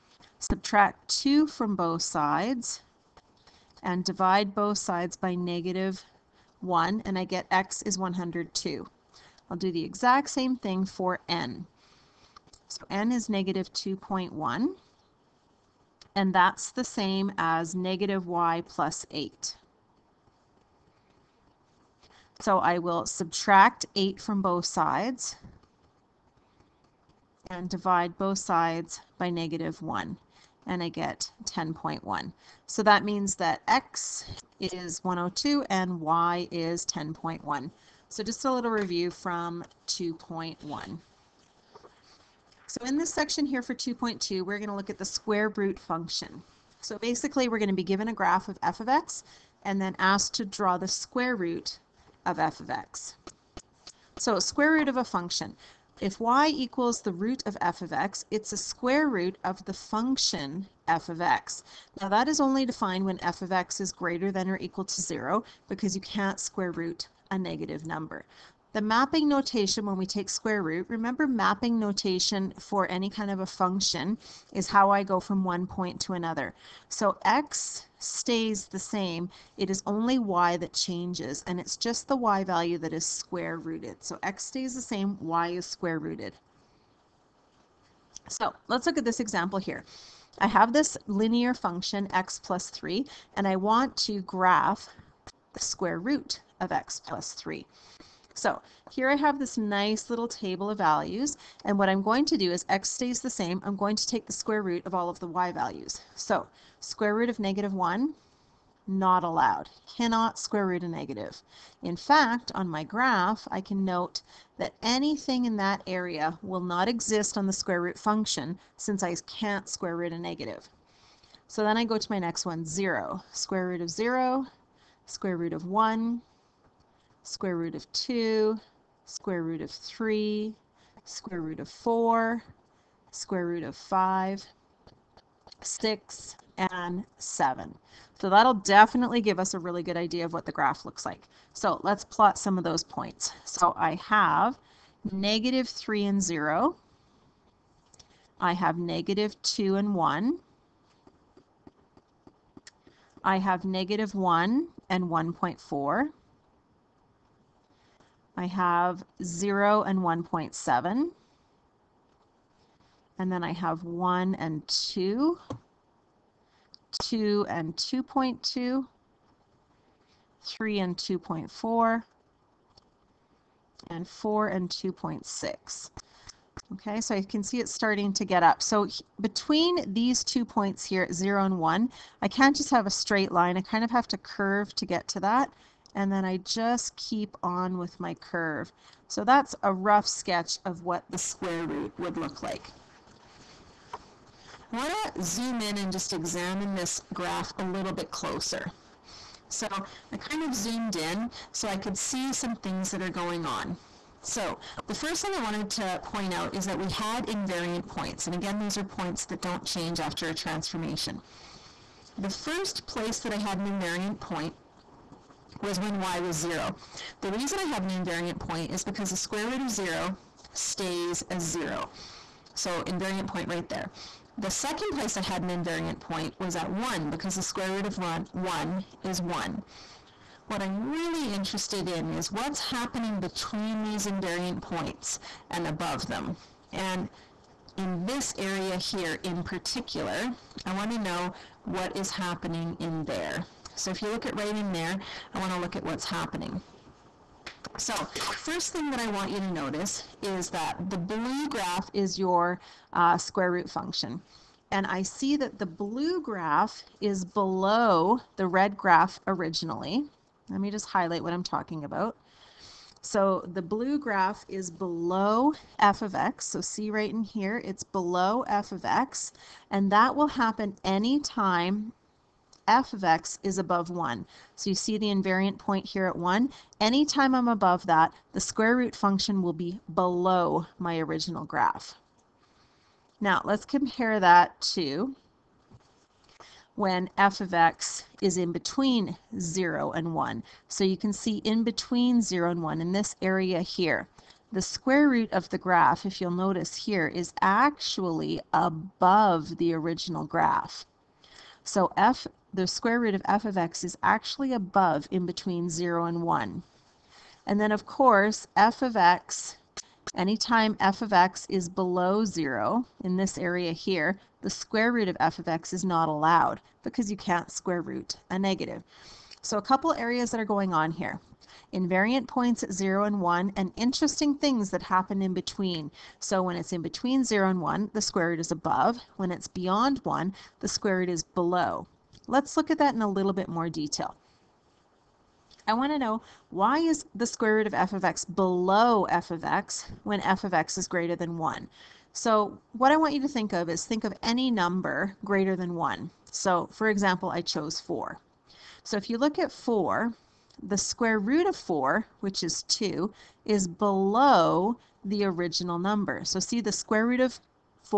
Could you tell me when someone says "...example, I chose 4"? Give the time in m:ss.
5:46.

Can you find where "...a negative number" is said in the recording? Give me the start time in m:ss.
1:07.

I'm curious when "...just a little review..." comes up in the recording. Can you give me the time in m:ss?
0:38.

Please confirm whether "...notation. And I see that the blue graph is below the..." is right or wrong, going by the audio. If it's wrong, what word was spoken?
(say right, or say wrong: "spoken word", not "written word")
wrong: "function", not "notation".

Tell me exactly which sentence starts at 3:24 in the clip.
So the first thing I wanted to point out is that we had invariant points.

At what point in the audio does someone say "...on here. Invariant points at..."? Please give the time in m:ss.
5:20.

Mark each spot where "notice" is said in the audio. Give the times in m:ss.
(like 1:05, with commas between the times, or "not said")
4:09, 4:56.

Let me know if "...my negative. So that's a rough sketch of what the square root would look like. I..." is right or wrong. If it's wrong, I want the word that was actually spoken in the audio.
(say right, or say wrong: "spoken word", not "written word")
wrong: "curve", not "negative".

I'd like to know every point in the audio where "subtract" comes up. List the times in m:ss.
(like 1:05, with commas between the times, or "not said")
0:00, 0:23.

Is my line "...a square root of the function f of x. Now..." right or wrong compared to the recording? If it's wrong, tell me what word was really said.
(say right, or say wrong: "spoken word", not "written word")
right.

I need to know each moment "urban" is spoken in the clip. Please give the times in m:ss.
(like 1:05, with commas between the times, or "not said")
not said.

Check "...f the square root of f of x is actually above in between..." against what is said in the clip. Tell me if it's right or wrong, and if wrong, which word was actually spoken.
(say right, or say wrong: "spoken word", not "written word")
right.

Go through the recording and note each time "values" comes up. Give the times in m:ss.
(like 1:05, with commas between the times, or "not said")
1:22, 1:40, 1:45.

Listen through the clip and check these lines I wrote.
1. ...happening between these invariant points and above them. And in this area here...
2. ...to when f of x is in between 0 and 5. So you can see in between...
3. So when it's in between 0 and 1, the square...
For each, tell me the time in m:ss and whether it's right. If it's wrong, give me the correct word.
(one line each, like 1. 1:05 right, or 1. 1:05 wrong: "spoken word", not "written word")
1. 3:52 right
2. 4:44 wrong: "1", not "5"
3. 5:26 right.